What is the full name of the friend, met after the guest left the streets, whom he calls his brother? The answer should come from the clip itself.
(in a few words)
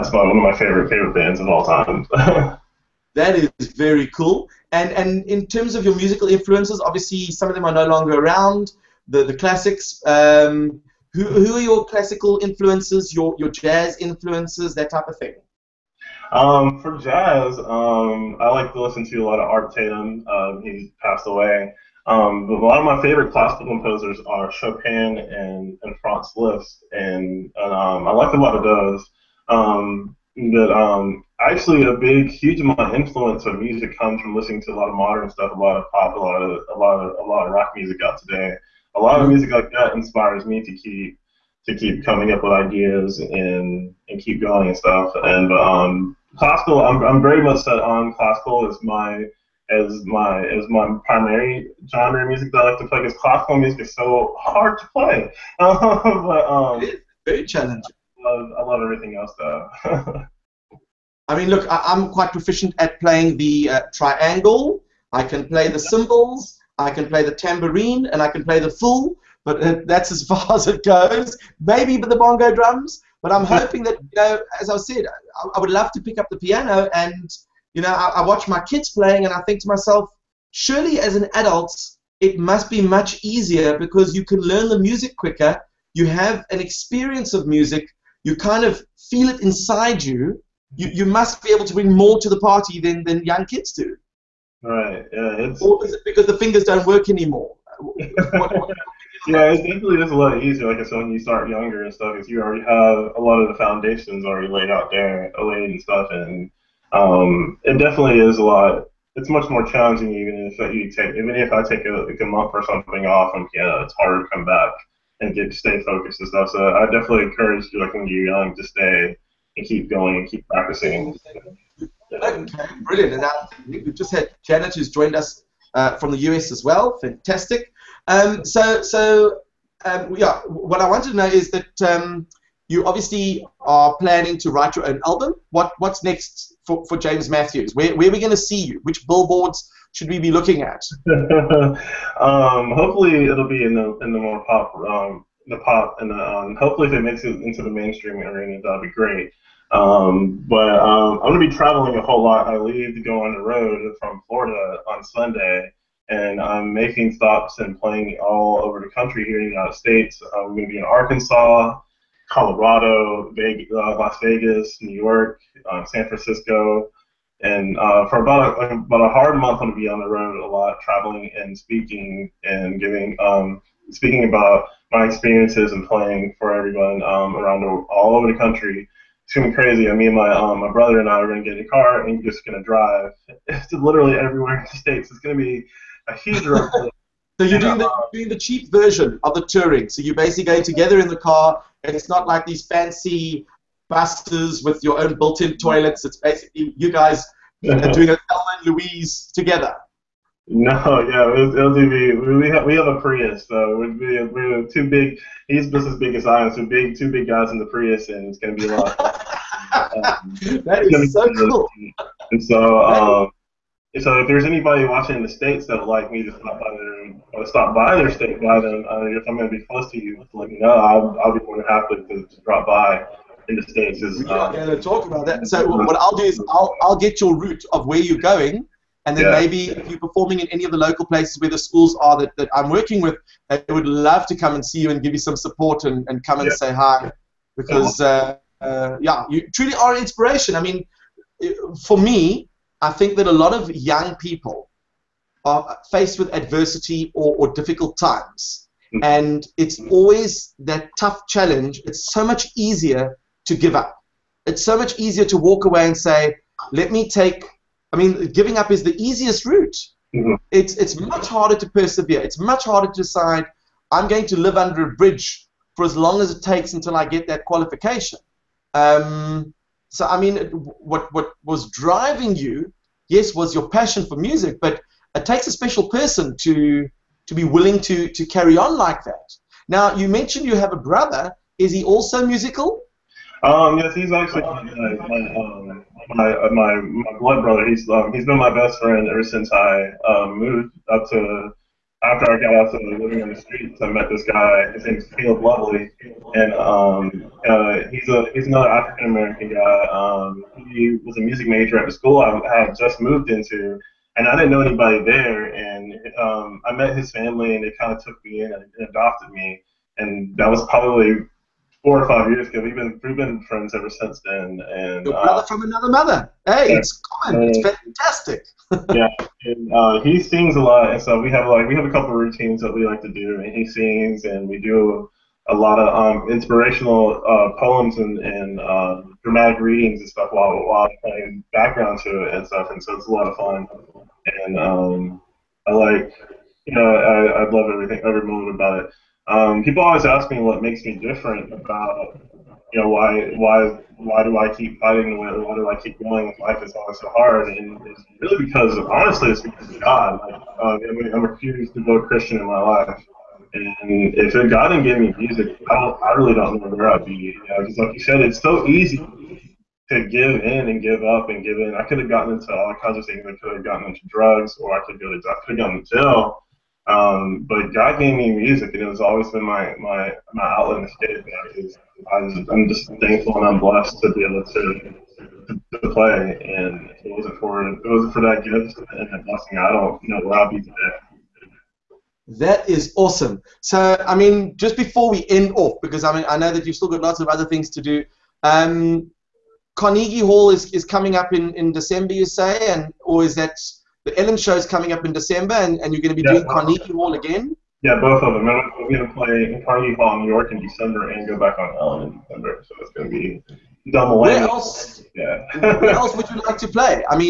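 Caleb Lovely.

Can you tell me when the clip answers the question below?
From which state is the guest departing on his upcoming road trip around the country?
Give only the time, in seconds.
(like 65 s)
154 s.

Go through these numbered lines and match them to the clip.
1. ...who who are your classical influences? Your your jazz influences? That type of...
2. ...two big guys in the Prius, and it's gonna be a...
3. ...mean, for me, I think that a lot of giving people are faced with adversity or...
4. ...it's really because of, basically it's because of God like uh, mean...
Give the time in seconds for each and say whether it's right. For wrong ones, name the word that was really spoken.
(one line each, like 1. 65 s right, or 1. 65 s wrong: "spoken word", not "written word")
1. 11 s right
2. 206 s right
3. 240 s wrong: "young", not "giving"
4. 347 s wrong: "honestly", not "basically".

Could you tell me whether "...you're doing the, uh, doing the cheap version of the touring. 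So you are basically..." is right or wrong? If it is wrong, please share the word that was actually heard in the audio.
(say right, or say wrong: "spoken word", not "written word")
right.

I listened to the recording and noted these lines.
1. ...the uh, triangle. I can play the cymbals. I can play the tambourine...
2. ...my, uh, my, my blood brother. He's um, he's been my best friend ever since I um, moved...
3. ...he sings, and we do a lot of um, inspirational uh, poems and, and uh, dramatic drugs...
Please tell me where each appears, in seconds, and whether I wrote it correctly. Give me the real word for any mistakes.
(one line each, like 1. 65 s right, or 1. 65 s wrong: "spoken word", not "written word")
1. 63 s right
2. 286 s right
3. 323 s wrong: "readings", not "drugs".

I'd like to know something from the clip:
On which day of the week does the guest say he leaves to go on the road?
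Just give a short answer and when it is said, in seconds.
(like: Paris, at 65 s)
Sunday, at 155 s.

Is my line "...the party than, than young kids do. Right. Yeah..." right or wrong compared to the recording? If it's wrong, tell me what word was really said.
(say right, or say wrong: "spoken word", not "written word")
right.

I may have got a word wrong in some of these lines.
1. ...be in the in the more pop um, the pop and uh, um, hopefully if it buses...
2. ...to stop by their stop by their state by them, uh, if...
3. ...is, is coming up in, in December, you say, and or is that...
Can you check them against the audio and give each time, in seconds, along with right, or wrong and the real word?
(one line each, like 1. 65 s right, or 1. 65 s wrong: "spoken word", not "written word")
1. 143 s wrong: "makes", not "buses"
2. 216 s right
3. 390 s right.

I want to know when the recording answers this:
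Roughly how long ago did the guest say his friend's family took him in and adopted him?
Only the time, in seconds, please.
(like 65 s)
311 s.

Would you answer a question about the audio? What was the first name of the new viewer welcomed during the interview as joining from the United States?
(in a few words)
Janet.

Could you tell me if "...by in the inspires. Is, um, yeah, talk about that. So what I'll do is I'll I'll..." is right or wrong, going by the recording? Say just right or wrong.
wrong.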